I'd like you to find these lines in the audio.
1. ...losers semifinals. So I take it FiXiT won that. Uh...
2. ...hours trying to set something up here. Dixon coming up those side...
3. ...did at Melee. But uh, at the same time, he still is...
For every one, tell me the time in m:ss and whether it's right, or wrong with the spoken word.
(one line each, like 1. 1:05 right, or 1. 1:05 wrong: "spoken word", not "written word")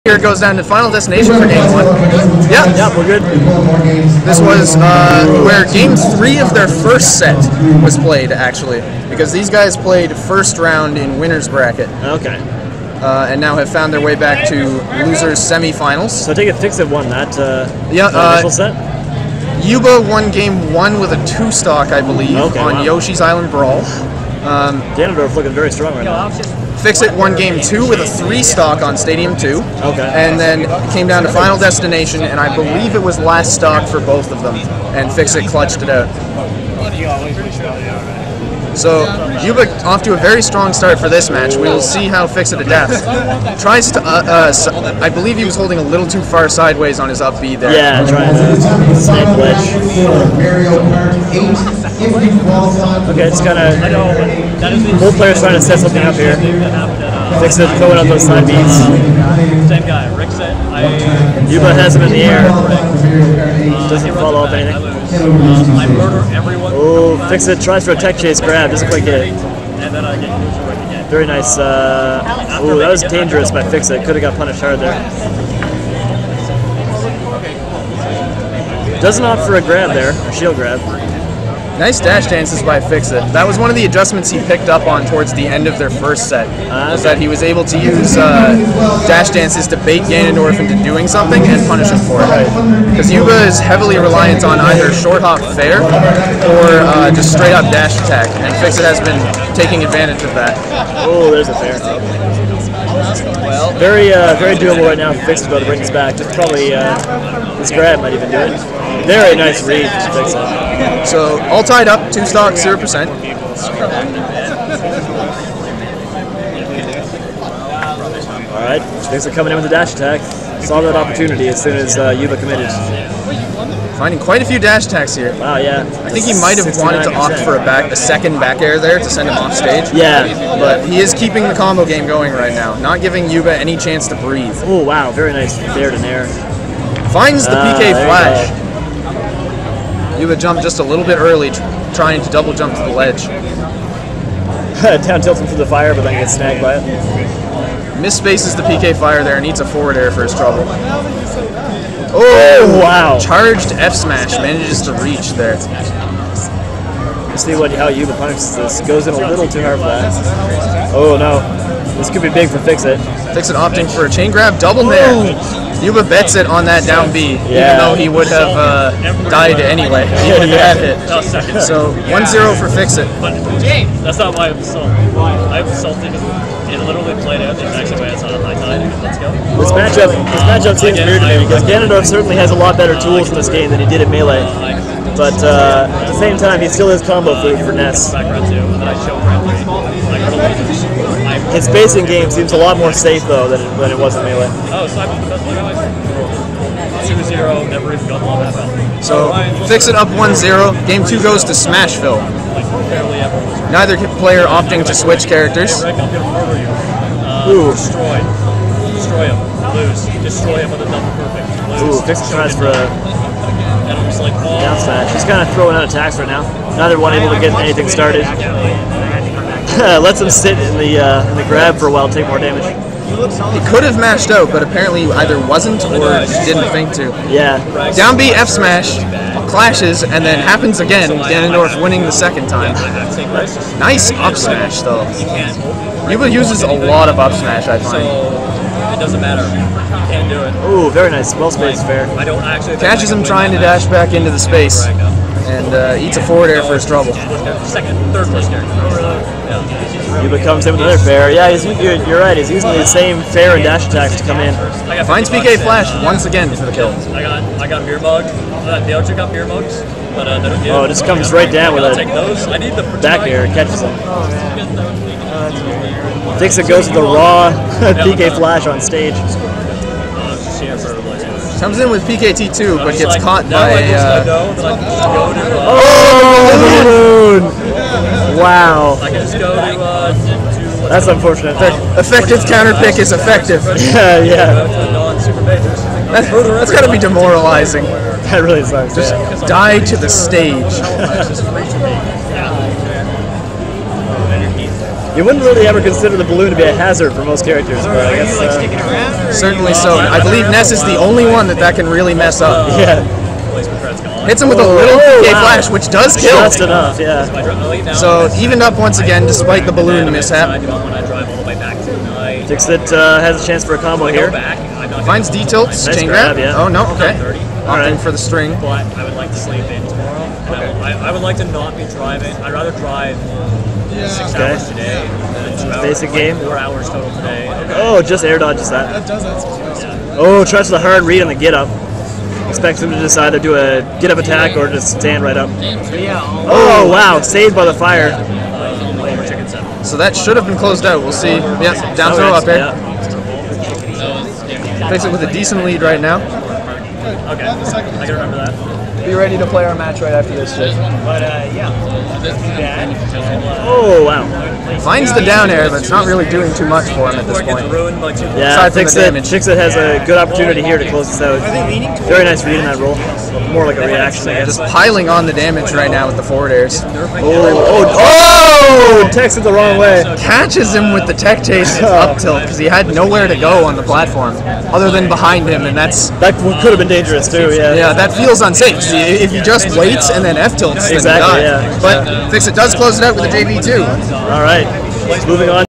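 1. 0:15 right
2. 0:55 wrong: "players", not "hours"
3. 3:03 right.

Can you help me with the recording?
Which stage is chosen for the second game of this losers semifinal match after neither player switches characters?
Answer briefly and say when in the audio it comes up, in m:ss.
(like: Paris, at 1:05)
Smashville, at 3:21.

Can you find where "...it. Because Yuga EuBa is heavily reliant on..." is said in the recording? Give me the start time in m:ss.
1:32.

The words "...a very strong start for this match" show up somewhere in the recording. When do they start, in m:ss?
0:40.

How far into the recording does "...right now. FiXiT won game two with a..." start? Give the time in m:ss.
0:25.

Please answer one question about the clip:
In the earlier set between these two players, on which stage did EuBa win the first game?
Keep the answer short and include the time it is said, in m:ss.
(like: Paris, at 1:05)
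Yoshi's Island Brawl, at 0:22.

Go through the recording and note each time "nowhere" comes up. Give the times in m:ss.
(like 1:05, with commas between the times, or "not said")
6:12.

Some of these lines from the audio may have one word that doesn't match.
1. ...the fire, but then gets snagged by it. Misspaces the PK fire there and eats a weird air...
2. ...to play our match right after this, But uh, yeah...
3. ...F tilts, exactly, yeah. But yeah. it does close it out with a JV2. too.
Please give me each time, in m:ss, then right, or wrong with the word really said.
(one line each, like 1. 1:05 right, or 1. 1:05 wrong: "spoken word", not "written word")
1. 2:25 wrong: "forward", not "weird"
2. 5:49 right
3. 6:20 right.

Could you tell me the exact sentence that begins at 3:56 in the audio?
EuBa uses a lot of up smash, I find doesn't matter.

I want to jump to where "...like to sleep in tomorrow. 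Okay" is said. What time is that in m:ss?
5:19.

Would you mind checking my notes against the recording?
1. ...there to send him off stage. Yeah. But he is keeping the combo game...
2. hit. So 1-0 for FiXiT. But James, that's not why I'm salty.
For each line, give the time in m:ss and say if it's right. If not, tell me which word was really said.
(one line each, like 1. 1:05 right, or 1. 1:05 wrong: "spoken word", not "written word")
1. 2:08 right
2. 2:50 right.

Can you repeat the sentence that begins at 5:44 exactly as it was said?
Face it with a decent lead right now.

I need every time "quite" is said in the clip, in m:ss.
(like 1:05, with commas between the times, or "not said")
1:08, 2:04.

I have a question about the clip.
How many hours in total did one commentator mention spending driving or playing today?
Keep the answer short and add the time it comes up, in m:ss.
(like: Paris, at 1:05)
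4, at 5:26.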